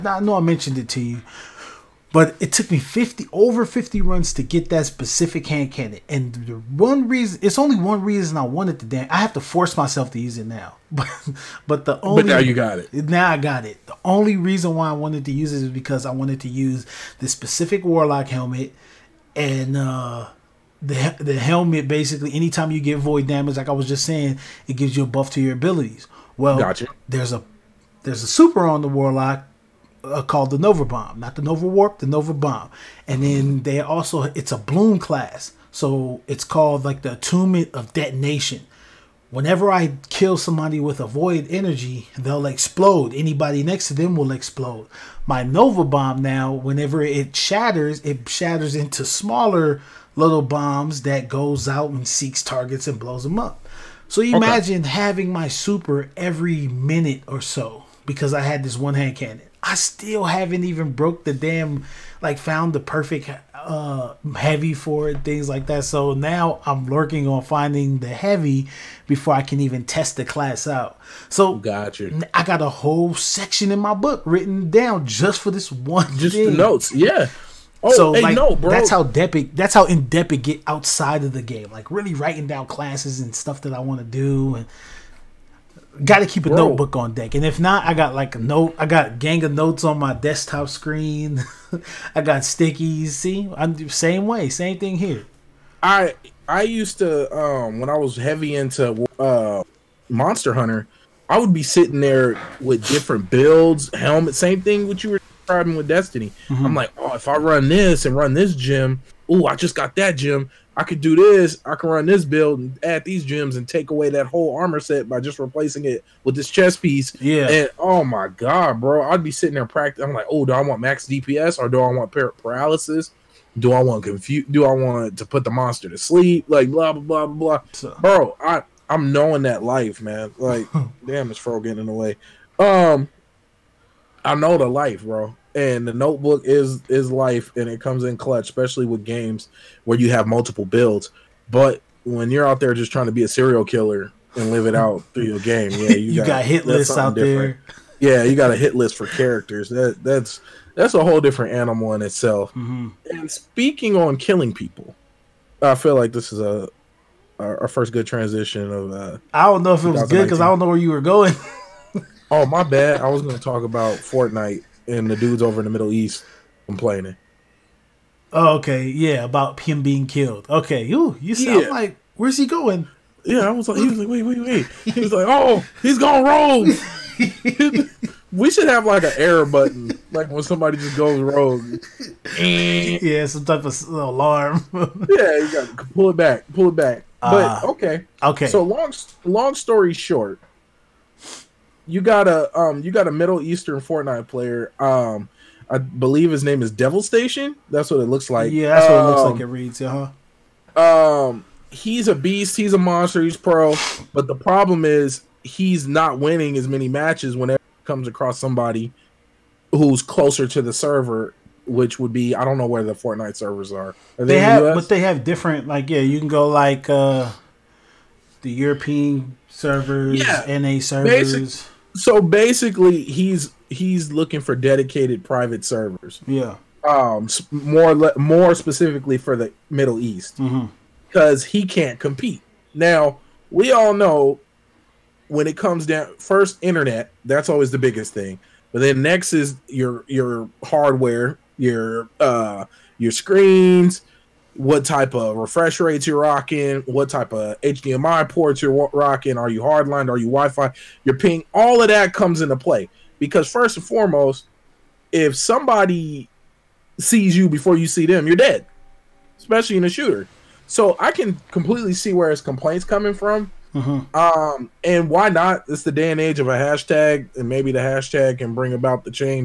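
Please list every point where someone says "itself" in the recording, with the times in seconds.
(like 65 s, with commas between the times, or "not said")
152 s.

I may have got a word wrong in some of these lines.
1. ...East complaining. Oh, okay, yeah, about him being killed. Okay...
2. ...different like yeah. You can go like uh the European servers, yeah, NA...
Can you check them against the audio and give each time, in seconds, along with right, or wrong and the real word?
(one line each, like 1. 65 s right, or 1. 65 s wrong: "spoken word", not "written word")
1. 165 s right
2. 215 s right.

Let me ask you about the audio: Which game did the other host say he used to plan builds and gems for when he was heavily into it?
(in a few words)
Monster Hunter.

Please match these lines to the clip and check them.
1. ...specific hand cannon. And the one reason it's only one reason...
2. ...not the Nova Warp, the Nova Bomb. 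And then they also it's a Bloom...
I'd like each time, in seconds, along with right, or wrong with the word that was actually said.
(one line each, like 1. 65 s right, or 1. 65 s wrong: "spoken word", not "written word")
1. 4 s right
2. 31 s right.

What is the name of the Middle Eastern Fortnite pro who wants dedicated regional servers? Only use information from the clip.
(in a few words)
Devil Station.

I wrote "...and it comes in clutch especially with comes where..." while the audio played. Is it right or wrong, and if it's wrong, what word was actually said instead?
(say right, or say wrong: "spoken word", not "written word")
wrong: "games", not "comes".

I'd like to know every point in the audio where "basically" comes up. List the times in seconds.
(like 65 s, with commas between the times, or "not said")
21 s, 222 s.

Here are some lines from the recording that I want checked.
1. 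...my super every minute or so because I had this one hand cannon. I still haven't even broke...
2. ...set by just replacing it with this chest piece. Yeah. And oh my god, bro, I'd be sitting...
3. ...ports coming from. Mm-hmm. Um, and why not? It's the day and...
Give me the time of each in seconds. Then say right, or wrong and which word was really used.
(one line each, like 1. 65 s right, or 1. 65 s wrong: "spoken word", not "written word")
1. 55 s right
2. 114 s right
3. 262 s wrong: "complaints", not "ports".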